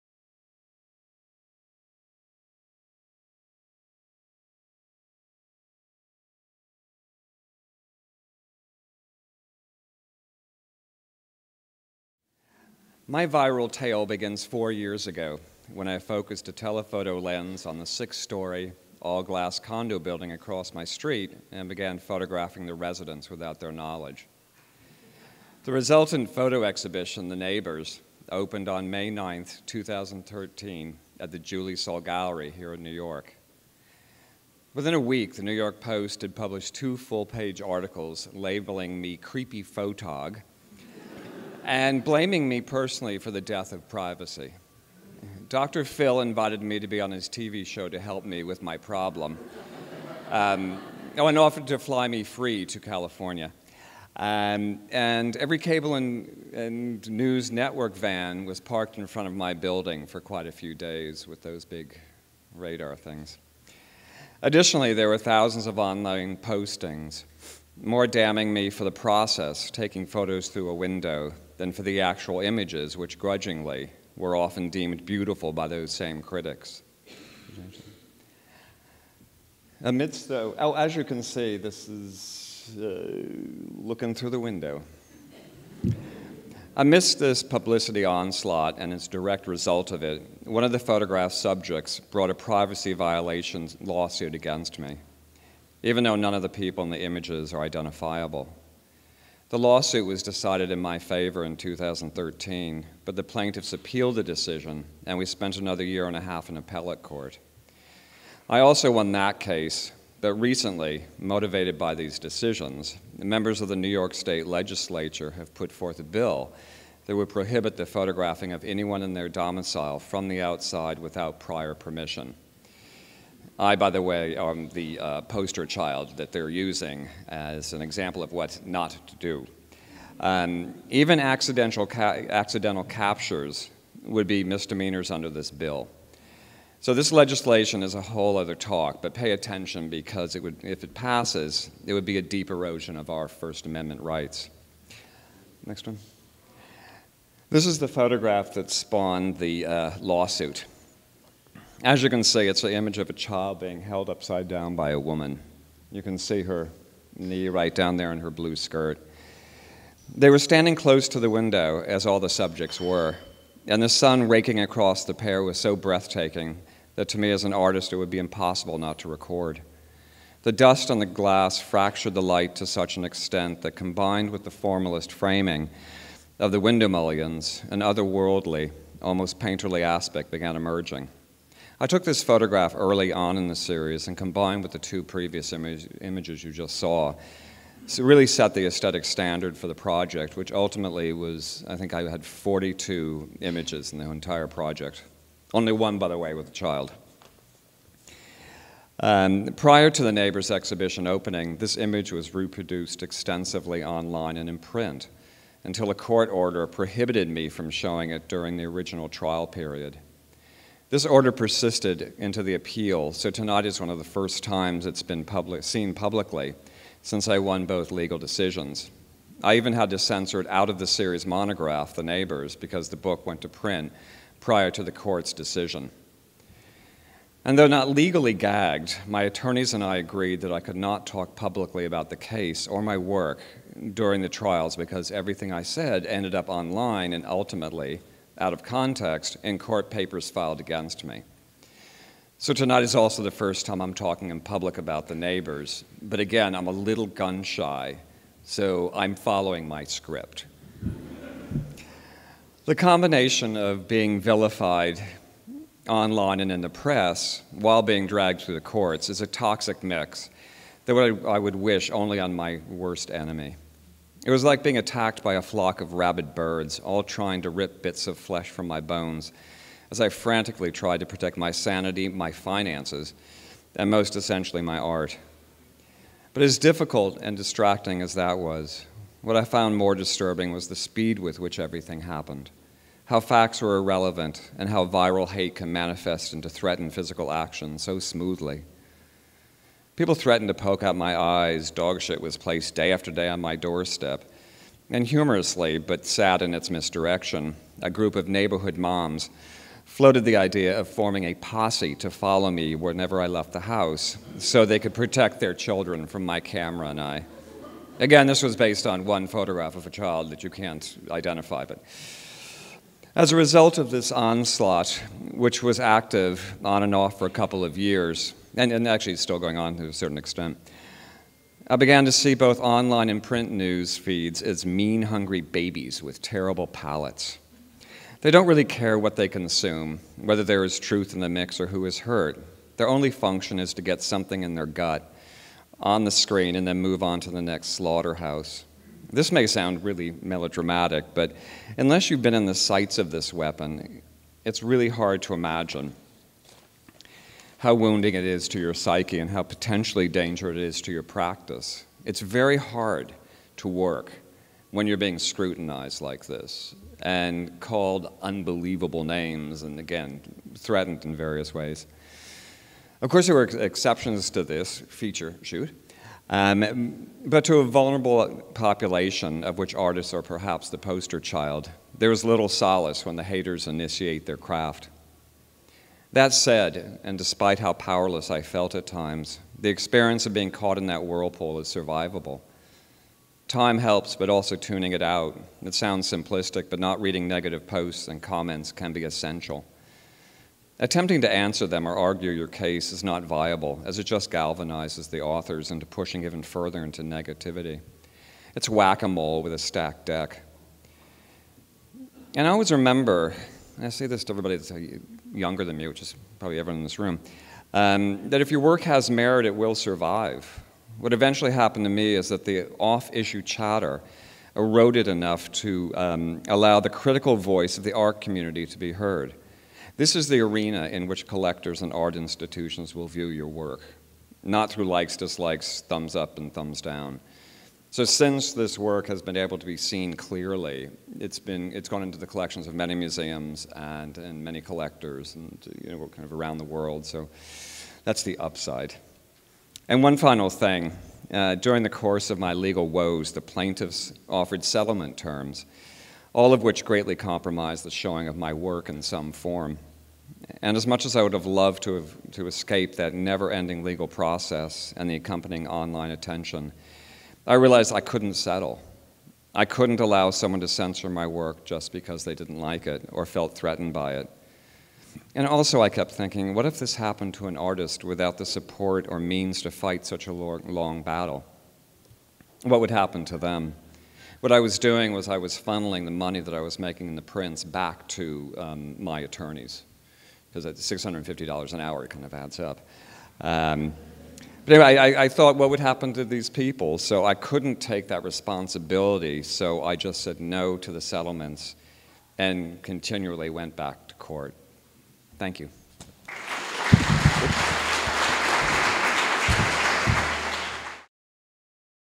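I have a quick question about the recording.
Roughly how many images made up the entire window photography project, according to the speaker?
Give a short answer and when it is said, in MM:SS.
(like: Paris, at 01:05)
42, at 03:12.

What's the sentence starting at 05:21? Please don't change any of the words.
I began to see both online and print news feeds as mean, hungry babies with terrible palates.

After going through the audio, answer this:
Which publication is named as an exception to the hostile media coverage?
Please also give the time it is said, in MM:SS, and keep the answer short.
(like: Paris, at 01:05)
Feature Shoot, at 06:04.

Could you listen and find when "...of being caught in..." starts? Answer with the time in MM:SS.
06:20.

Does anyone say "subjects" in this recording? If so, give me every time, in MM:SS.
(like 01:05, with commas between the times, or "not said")
01:31, 02:42.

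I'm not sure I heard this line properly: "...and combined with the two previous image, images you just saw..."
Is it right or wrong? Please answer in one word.
right.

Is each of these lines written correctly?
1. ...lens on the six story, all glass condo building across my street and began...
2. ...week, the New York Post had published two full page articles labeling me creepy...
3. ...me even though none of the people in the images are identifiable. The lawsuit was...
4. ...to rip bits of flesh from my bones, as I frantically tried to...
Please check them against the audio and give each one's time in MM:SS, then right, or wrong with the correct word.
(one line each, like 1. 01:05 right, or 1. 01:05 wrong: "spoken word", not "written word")
1. 00:17 right
2. 00:35 right
3. 01:34 right
4. 04:27 right.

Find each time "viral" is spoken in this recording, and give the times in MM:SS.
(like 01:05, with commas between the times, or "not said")
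00:13, 04:44.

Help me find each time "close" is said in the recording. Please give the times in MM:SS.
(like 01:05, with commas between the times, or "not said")
02:40.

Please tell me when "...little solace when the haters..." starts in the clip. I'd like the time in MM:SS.
06:12.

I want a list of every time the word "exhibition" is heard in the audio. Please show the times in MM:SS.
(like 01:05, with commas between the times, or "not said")
00:26, 03:20.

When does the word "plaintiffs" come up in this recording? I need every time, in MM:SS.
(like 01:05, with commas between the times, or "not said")
01:43, 07:23.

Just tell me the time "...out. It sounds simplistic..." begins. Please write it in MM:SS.
06:25.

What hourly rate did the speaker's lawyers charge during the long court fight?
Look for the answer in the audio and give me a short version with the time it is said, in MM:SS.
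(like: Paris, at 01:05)
$650 an hour, at 08:00.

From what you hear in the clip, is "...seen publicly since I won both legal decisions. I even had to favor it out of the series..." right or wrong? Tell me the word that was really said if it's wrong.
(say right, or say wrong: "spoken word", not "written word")
wrong: "censor", not "favor".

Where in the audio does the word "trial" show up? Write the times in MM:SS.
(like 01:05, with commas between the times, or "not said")
03:29, 03:54.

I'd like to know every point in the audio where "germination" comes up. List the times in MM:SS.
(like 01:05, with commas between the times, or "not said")
not said.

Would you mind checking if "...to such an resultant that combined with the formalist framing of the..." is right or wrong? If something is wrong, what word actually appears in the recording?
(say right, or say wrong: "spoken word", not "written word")
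wrong: "extent", not "resultant".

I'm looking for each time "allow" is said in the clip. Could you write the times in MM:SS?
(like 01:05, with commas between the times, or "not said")
06:56, 07:39.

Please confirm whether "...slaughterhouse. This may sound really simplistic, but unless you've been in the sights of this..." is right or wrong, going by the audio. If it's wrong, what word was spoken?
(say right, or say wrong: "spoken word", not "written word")
wrong: "melodramatic", not "simplistic".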